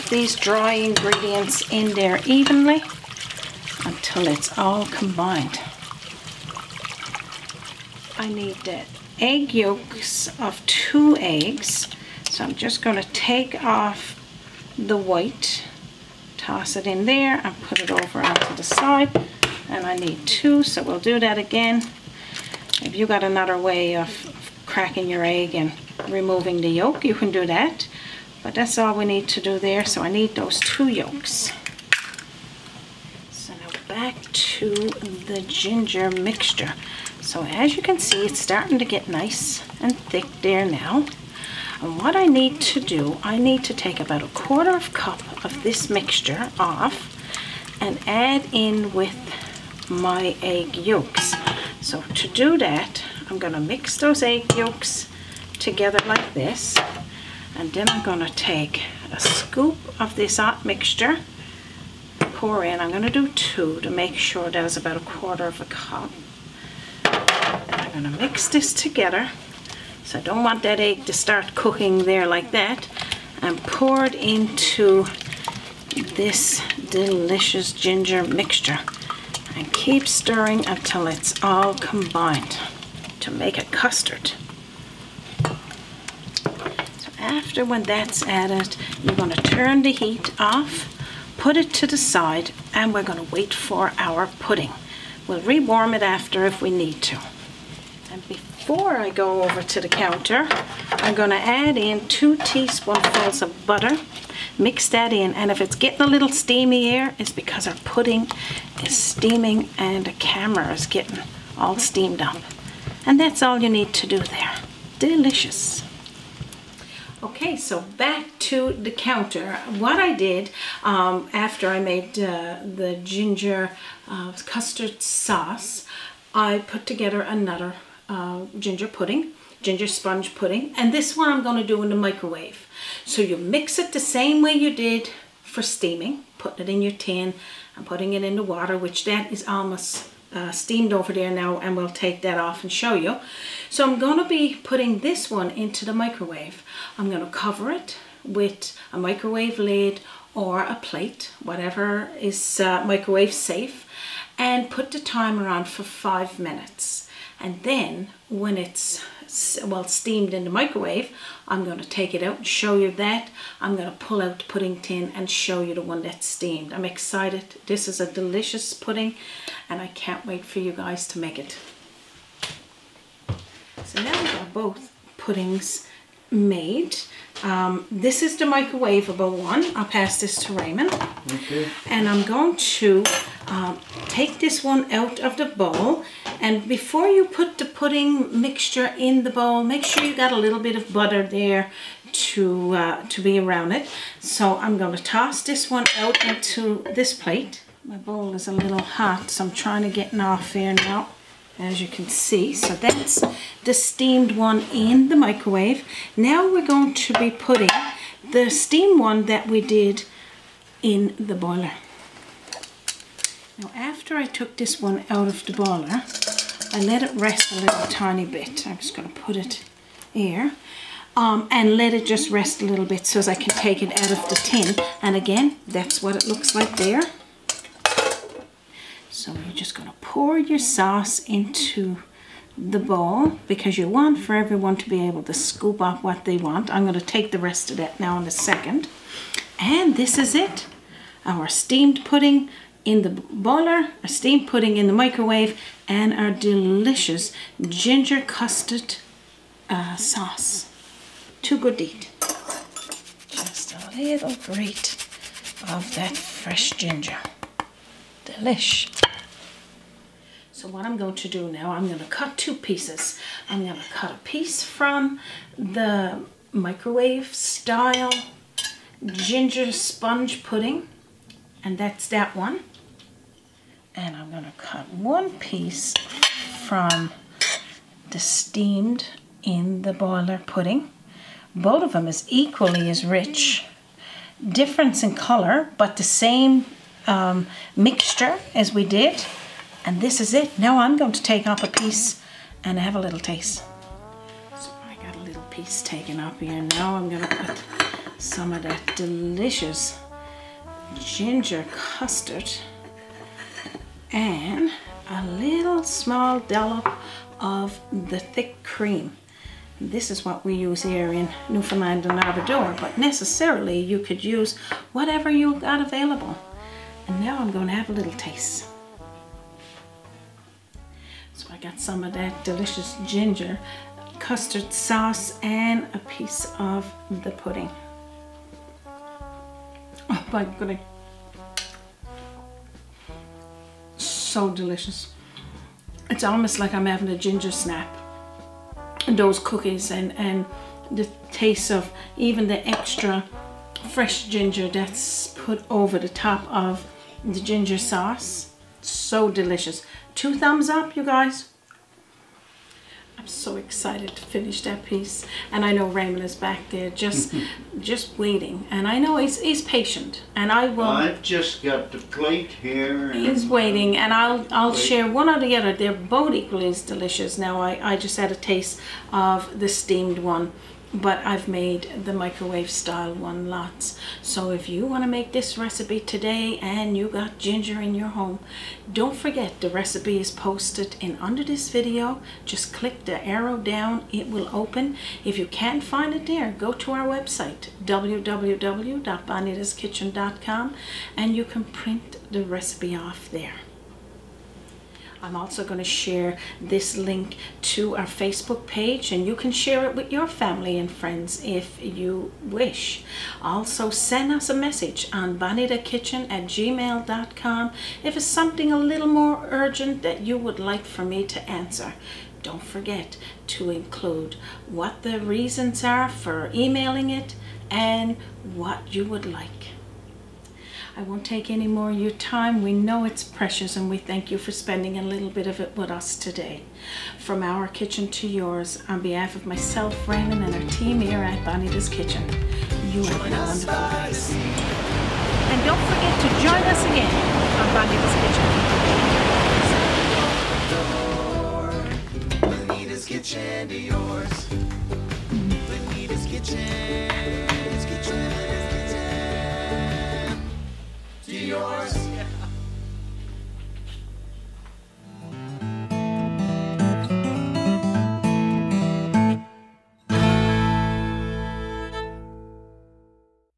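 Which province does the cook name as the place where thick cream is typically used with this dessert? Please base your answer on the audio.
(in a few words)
Newfoundland and Labrador.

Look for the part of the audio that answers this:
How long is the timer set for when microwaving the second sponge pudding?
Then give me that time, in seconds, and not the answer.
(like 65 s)
155 s.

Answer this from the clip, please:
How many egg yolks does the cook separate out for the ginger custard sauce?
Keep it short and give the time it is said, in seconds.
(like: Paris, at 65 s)
2, at 9 s.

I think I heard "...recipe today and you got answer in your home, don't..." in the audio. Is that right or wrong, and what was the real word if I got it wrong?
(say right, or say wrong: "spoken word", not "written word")
wrong: "ginger", not "answer".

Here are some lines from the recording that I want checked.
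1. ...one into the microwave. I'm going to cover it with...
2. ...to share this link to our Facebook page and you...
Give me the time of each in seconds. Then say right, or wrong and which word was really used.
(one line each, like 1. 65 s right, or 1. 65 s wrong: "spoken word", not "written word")
1. 145 s right
2. 395 s right.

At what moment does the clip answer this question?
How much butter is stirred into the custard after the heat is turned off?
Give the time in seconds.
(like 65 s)
102 s.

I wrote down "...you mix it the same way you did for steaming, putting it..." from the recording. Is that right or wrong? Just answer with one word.
right.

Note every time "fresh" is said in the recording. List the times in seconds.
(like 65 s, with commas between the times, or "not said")
256 s, 343 s.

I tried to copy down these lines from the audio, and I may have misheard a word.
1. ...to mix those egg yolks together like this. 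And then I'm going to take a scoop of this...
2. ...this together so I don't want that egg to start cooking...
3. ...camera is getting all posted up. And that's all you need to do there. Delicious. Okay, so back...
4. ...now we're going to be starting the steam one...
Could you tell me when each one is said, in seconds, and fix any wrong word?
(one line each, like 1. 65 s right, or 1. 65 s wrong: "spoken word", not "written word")
1. 53 s right
2. 68 s right
3. 110 s wrong: "steamed", not "posted"
4. 206 s wrong: "putting", not "starting".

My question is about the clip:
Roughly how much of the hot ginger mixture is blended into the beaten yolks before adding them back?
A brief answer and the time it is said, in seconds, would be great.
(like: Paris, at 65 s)
a quarter of a cup, at 64 s.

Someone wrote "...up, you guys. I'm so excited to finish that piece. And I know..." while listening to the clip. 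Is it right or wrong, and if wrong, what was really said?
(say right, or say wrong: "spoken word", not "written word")
right.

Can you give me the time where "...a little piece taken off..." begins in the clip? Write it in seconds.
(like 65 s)
295 s.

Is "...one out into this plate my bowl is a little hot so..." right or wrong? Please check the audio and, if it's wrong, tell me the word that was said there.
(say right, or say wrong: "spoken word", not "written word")
right.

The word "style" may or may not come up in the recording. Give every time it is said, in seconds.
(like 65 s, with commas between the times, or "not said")
267 s, 372 s.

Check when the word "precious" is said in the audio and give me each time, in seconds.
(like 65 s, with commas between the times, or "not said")
423 s.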